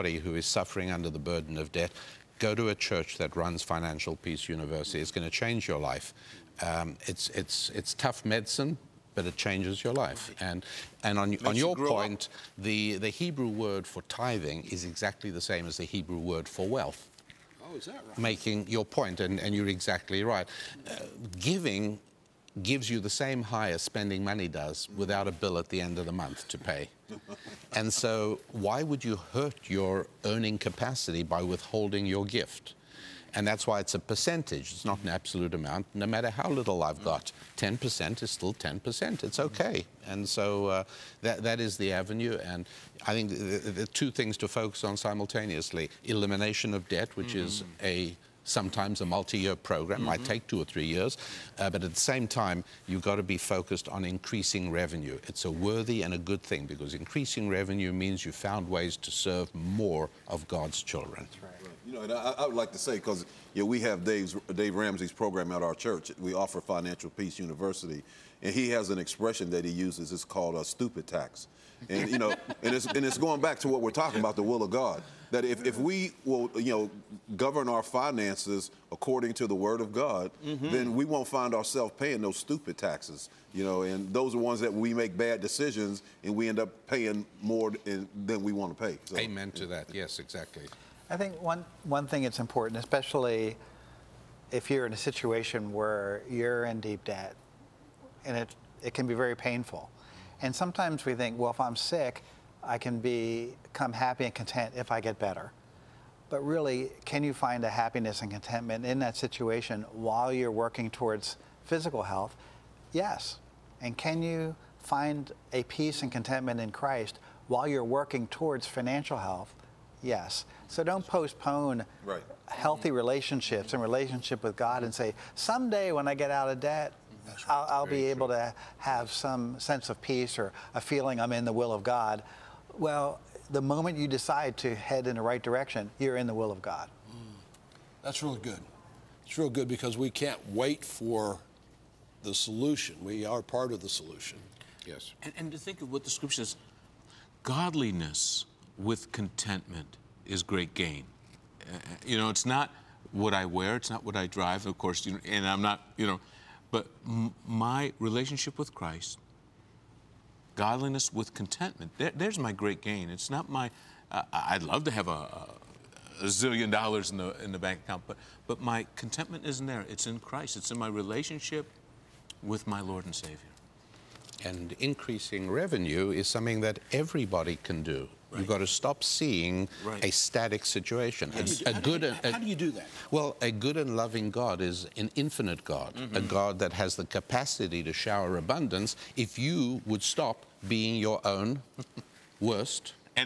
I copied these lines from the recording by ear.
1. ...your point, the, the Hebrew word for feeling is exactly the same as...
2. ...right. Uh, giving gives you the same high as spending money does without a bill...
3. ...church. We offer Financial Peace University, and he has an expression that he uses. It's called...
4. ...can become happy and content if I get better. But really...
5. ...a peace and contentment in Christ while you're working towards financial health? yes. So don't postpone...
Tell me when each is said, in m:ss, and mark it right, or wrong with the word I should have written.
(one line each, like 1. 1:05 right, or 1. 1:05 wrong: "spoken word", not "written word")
1. 0:11 wrong: "tithing", not "feeling"
2. 0:20 right
3. 1:05 right
4. 1:42 right
5. 1:55 right.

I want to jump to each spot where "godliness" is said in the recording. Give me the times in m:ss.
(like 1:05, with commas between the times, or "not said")
2:27, 2:40.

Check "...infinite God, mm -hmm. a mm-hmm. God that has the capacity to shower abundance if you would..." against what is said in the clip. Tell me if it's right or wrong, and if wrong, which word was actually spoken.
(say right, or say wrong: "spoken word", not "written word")
right.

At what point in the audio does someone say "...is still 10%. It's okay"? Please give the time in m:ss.
0:38.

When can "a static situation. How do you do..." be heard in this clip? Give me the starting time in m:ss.
3:00.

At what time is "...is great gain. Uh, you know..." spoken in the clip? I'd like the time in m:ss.
2:30.